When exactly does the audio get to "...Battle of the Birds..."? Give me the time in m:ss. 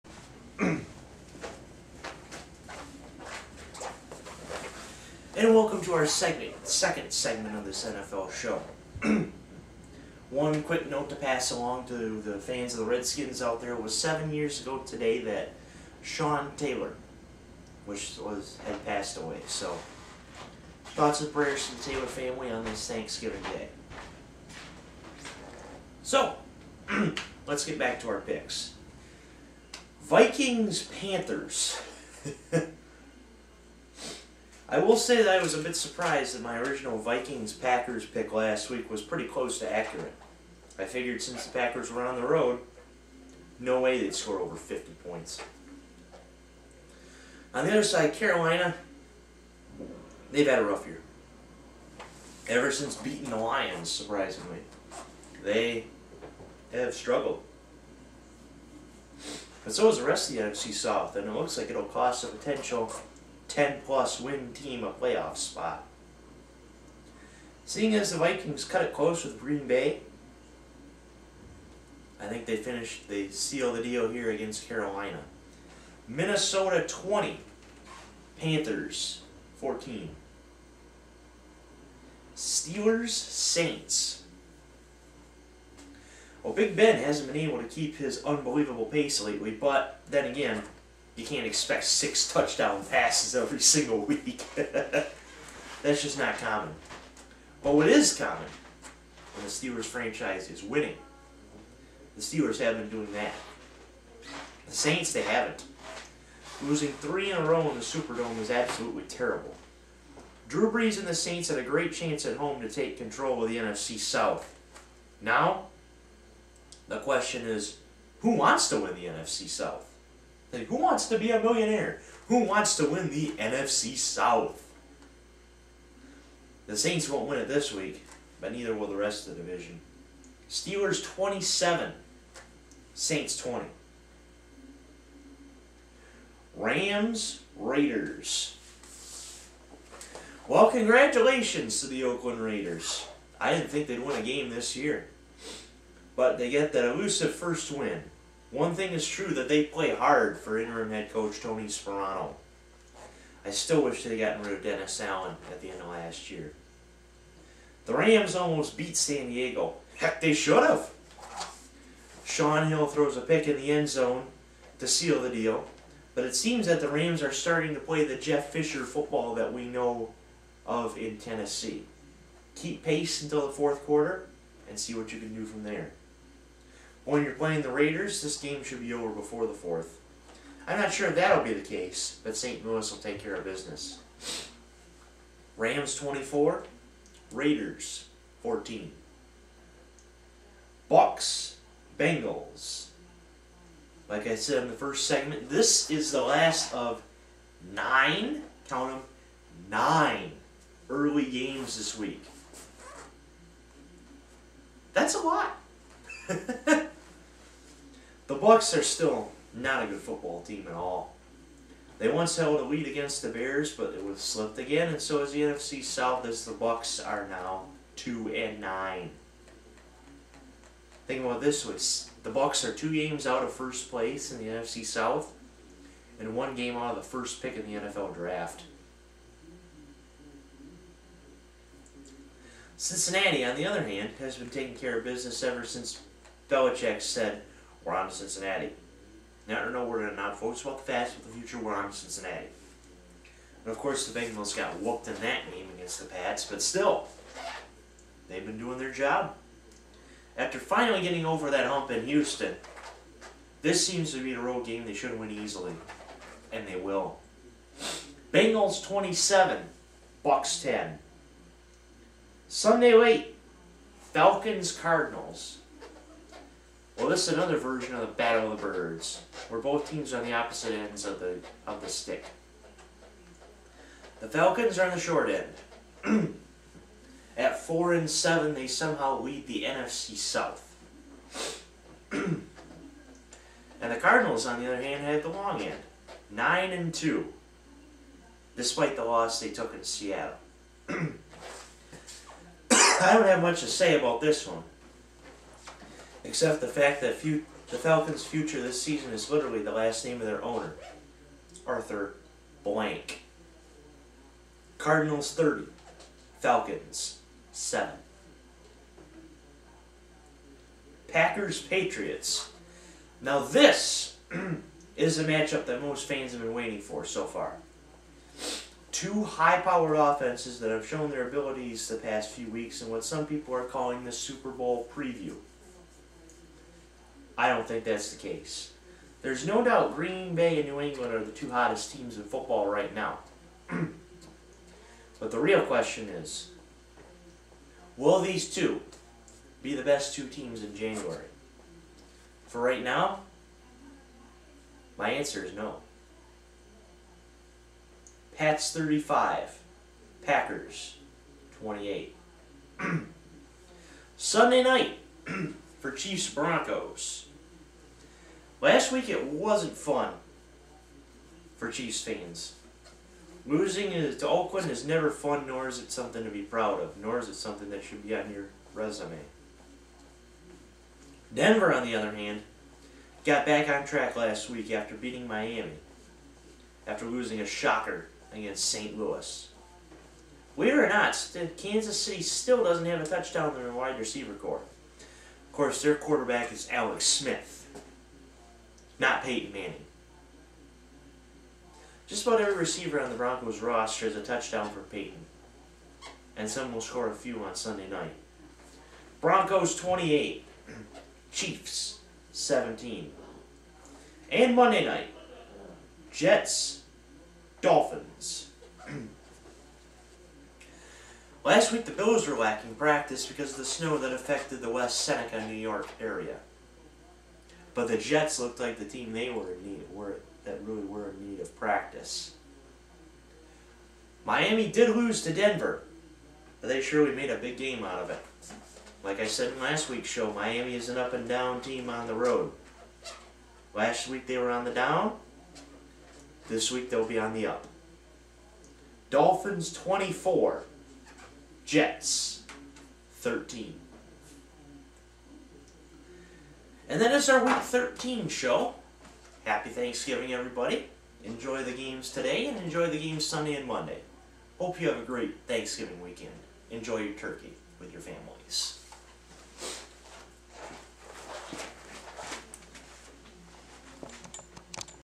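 4:28.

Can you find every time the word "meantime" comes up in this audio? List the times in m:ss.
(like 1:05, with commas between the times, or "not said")
not said.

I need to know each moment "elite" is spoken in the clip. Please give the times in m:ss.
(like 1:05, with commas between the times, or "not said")
not said.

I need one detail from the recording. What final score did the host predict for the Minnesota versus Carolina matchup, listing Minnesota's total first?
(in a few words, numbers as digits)
20-14.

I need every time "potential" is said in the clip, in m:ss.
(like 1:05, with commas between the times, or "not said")
1:02.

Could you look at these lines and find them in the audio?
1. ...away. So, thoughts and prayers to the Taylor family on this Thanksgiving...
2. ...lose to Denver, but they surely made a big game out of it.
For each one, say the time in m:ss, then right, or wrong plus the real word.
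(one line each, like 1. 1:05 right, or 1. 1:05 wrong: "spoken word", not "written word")
1. 0:19 right
2. 7:04 right.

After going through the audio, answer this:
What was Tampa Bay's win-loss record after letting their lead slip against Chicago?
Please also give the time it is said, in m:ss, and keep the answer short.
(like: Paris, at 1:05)
2-9, at 3:37.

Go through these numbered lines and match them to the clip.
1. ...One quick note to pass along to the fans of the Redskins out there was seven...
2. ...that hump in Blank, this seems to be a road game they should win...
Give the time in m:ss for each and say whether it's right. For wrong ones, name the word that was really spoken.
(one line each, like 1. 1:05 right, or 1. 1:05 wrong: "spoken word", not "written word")
1. 0:10 right
2. 4:11 wrong: "Houston", not "Blank".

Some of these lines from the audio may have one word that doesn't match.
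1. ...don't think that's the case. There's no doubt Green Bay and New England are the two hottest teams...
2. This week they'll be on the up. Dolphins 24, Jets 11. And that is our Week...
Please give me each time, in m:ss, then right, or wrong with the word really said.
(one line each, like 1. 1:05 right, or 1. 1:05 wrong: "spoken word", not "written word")
1. 5:27 right
2. 7:16 wrong: "13", not "11".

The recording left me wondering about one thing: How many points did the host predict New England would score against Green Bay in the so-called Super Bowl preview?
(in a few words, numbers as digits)
35.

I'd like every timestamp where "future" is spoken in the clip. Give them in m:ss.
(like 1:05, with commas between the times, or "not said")
4:01, 4:58.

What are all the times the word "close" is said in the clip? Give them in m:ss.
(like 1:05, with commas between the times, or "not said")
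0:39, 1:08.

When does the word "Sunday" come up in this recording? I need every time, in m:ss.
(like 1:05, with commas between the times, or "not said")
4:22, 5:54, 6:37, 7:33.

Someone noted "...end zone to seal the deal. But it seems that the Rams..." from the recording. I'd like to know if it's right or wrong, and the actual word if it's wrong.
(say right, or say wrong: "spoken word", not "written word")
right.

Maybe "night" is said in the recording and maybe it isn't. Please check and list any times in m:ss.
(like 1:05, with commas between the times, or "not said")
5:54, 6:37, 6:44.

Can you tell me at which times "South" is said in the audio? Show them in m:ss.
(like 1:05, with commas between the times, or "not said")
1:00, 1:53, 1:59, 2:03, 3:35, 3:44, 4:40.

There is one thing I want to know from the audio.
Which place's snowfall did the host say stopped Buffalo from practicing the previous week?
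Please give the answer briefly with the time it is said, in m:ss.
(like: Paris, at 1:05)
West Seneca, New York, at 6:54.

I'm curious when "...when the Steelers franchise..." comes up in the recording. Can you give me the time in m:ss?
1:39.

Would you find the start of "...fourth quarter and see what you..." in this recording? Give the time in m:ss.
2:53.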